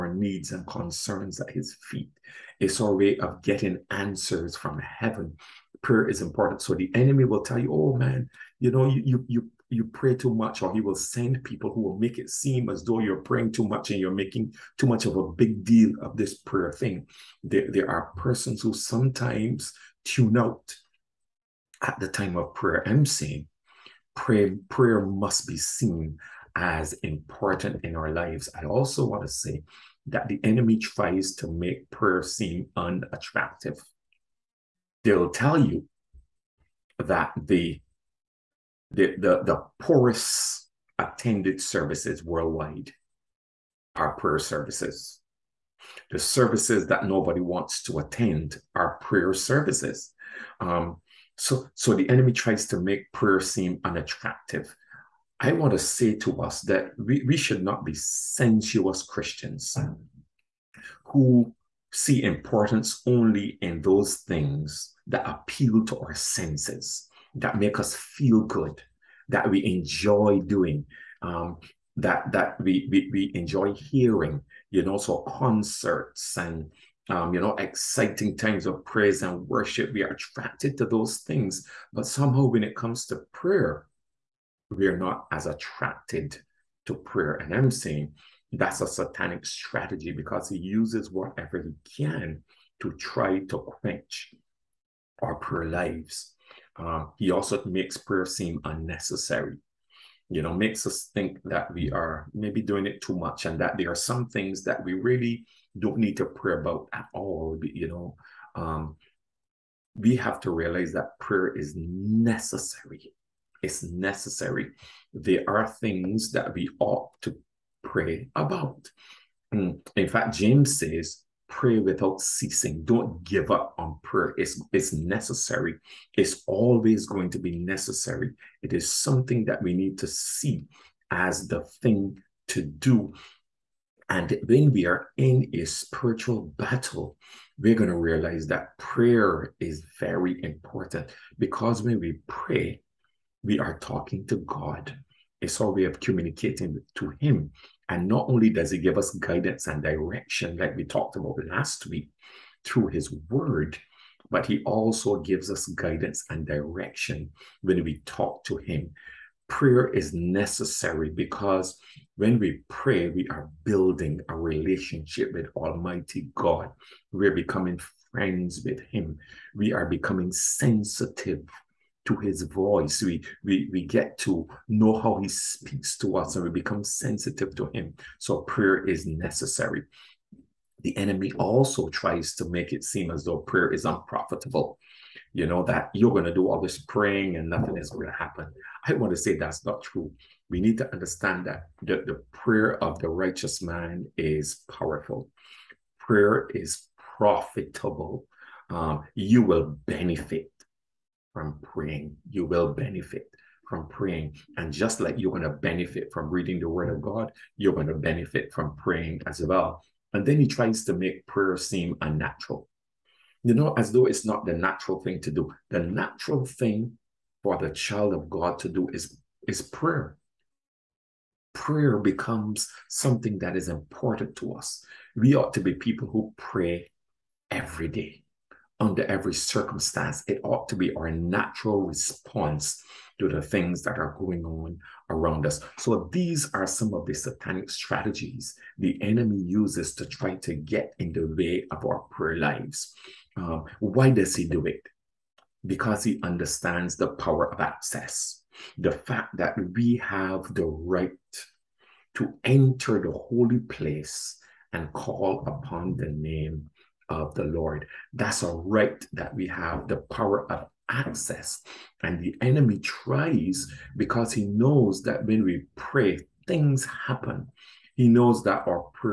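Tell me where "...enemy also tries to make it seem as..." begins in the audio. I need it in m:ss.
3:00.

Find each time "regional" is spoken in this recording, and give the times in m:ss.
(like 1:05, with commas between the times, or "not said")
not said.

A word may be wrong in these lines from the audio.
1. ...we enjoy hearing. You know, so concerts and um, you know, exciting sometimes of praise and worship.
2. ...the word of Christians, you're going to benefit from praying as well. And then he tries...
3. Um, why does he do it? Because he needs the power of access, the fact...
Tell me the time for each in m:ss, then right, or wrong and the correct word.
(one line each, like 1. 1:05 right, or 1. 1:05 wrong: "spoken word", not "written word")
1. 1:13 wrong: "times", not "sometimes"
2. 3:26 wrong: "God", not "Christians"
3. 4:03 wrong: "understands", not "needs".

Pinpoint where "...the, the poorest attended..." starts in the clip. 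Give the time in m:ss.
0:39.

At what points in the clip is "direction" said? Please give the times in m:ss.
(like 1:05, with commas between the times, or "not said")
2:29, 2:36.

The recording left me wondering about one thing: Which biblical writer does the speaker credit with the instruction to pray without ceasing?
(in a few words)
James.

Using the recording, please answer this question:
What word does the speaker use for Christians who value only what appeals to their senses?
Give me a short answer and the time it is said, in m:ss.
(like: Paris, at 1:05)
Sensuous, at 0:57.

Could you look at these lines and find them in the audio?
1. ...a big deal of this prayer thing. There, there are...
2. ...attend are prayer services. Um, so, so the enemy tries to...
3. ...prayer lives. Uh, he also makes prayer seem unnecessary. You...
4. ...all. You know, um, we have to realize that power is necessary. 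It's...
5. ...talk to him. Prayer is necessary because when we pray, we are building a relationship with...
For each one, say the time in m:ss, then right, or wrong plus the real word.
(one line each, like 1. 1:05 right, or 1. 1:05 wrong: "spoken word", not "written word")
1. 0:15 right
2. 0:47 right
3. 1:35 right
4. 1:47 wrong: "prayer", not "power"
5. 2:38 right.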